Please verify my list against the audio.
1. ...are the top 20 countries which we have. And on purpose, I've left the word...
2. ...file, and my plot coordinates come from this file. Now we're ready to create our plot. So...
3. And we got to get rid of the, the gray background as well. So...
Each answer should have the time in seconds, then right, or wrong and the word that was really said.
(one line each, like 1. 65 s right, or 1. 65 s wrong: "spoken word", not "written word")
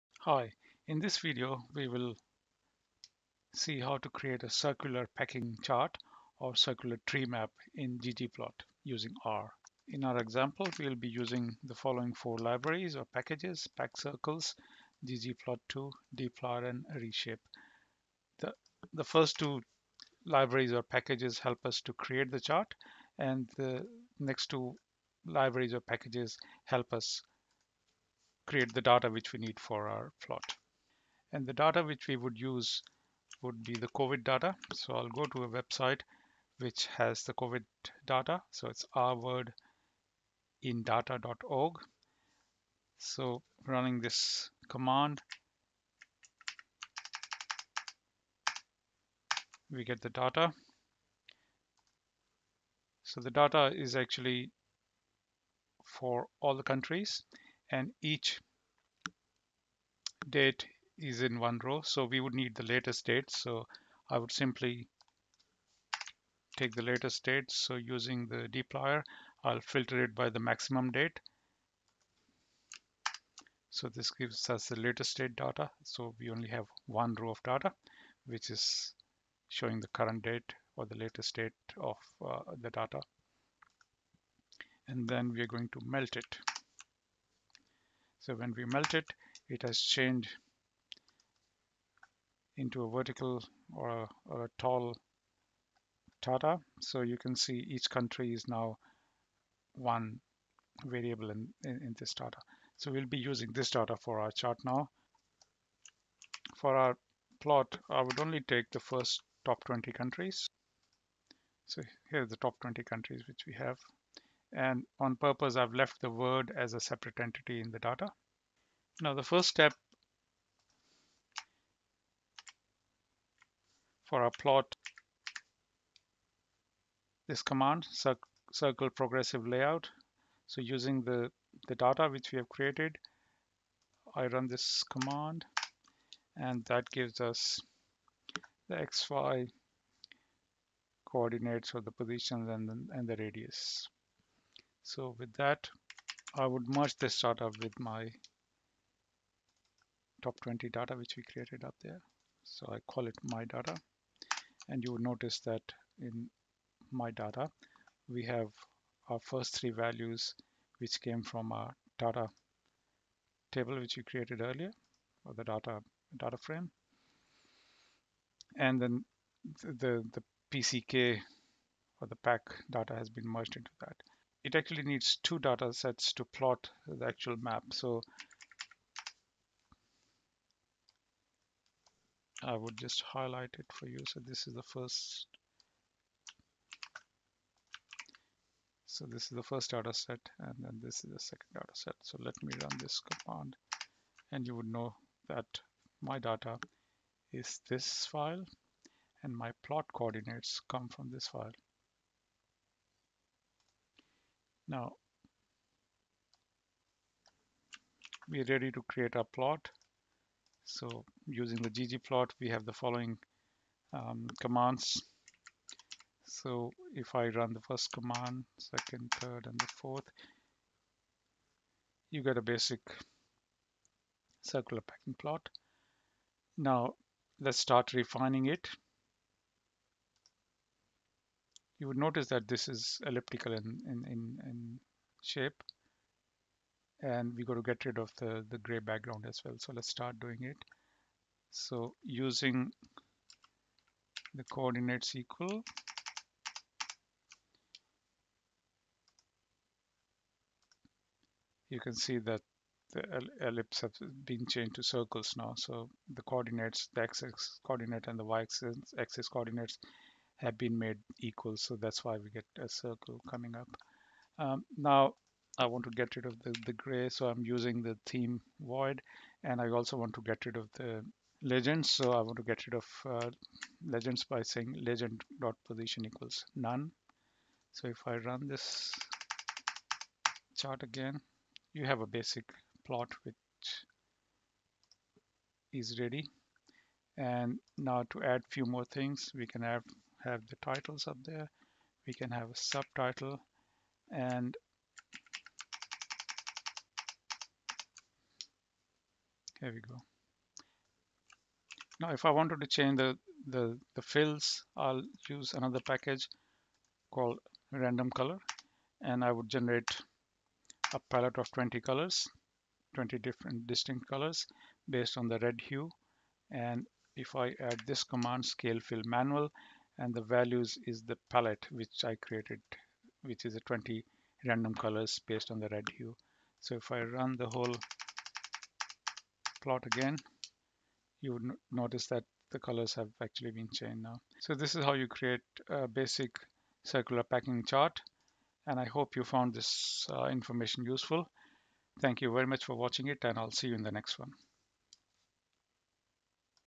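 1. 112 s right
2. 198 s right
3. 237 s right.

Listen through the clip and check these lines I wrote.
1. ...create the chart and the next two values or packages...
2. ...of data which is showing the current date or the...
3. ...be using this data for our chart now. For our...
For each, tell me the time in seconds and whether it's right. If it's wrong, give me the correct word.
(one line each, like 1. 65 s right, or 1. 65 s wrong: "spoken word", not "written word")
1. 21 s wrong: "libraries", not "values"
2. 77 s right
3. 103 s right.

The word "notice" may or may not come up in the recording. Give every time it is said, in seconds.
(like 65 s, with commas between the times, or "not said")
155 s, 231 s, 331 s.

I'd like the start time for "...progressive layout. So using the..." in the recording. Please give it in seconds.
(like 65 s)
128 s.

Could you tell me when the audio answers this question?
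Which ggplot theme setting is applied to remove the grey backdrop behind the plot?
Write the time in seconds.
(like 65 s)
268 s.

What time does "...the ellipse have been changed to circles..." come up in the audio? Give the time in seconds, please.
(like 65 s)
252 s.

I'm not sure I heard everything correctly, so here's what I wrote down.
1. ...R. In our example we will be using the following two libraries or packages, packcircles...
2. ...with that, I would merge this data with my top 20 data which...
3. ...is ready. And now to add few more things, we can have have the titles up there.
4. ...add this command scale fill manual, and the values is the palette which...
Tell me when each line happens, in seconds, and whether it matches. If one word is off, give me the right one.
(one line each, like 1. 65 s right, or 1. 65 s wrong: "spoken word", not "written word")
1. 9 s wrong: "four", not "two"
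2. 145 s right
3. 285 s right
4. 317 s right.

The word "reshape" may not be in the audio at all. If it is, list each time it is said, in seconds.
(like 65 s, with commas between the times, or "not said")
16 s.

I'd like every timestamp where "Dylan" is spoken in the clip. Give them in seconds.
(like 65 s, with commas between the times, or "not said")
not said.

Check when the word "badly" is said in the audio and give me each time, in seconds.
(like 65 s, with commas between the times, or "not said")
not said.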